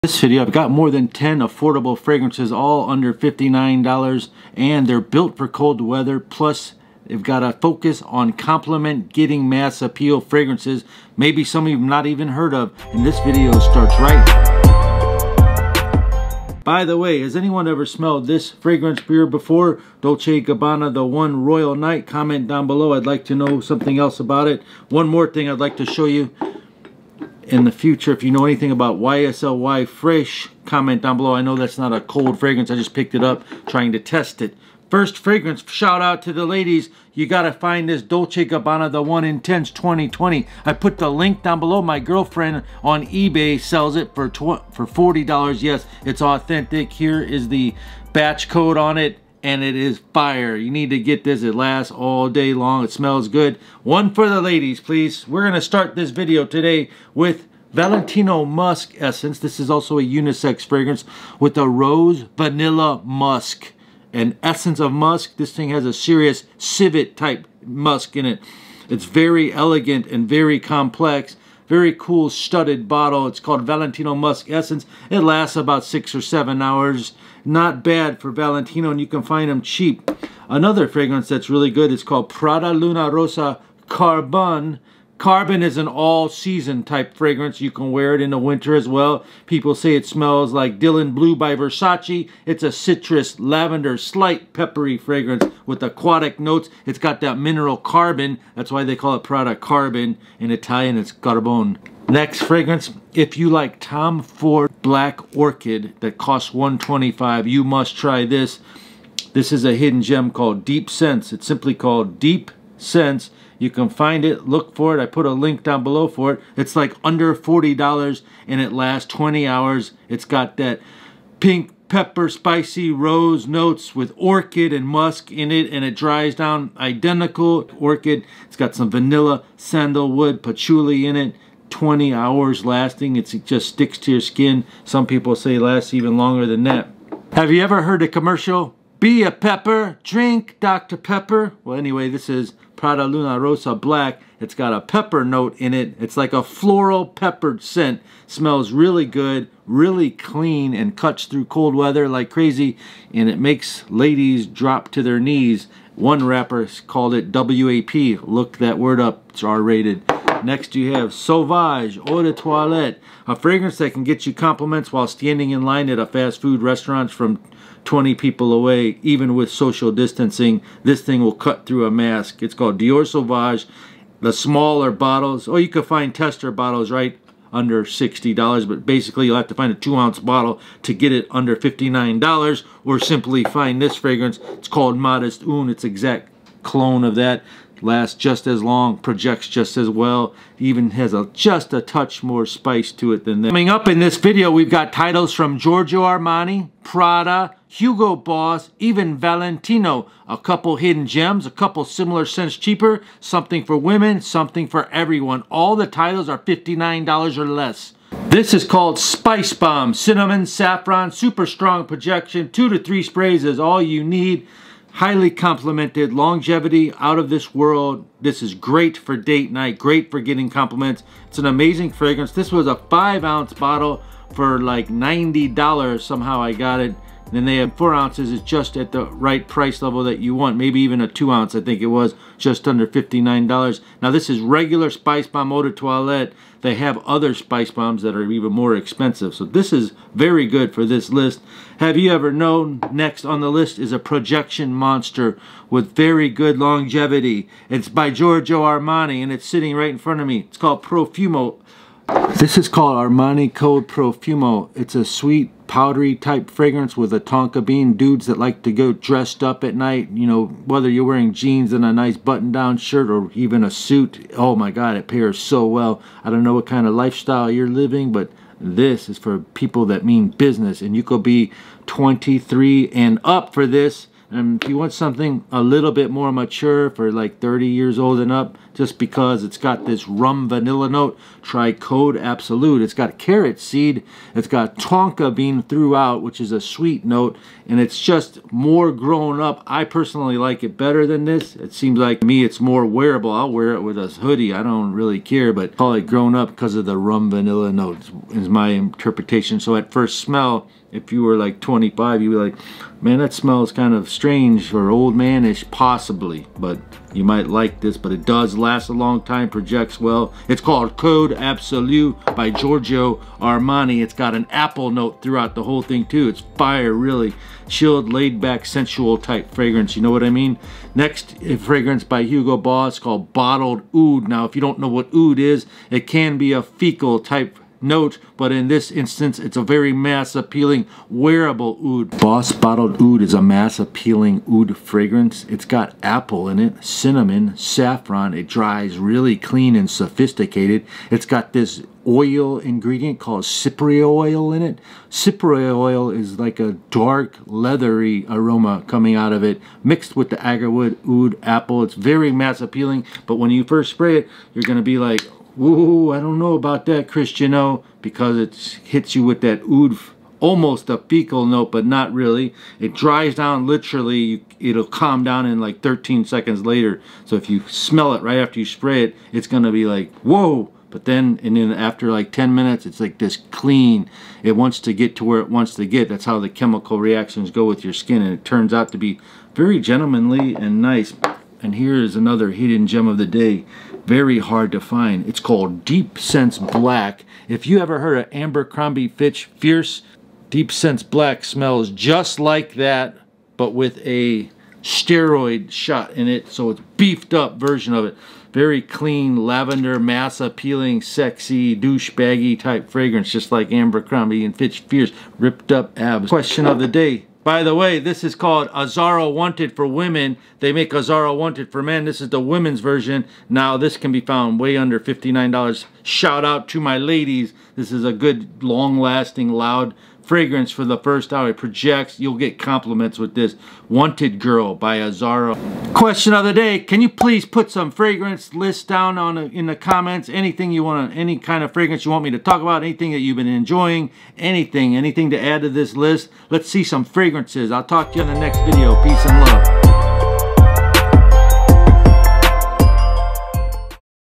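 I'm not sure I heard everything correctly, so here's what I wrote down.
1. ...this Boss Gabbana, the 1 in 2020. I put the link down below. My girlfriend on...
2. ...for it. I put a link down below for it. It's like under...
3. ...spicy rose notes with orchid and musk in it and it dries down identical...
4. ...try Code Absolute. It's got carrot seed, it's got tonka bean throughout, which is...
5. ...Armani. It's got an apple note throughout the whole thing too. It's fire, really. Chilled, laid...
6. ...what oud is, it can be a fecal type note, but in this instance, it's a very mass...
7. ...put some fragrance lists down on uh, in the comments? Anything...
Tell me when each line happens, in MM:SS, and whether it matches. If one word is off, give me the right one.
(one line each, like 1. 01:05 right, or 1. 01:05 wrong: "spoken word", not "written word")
1. 00:37 wrong: "Dolce", not "Boss"
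2. 01:54 right
3. 02:02 right
4. 04:41 right
5. 05:13 right
6. 05:24 right
7. 07:07 right.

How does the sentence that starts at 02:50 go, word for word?
This thing will cut through a mask.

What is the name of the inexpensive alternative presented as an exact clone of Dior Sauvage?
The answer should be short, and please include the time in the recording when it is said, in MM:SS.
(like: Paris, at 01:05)
Modest Une, at 03:04.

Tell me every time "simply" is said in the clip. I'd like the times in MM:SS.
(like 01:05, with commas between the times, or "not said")
01:51, 03:02.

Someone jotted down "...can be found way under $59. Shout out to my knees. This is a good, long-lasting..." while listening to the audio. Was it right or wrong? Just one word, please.
wrong.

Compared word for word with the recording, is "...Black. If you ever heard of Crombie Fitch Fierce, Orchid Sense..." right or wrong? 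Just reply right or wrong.
wrong.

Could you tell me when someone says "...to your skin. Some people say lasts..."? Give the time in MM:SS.
02:13.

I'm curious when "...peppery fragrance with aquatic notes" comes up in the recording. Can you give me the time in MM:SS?
01:34.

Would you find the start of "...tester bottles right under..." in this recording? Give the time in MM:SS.
02:56.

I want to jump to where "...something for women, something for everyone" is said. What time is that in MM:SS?
03:23.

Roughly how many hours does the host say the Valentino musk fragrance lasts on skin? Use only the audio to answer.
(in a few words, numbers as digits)
six or seven hours.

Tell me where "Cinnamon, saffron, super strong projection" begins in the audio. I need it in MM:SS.
03:29.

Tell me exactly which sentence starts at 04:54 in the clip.
I don't really care, but call it grown up because of the rum vanilla notes is my interpretation.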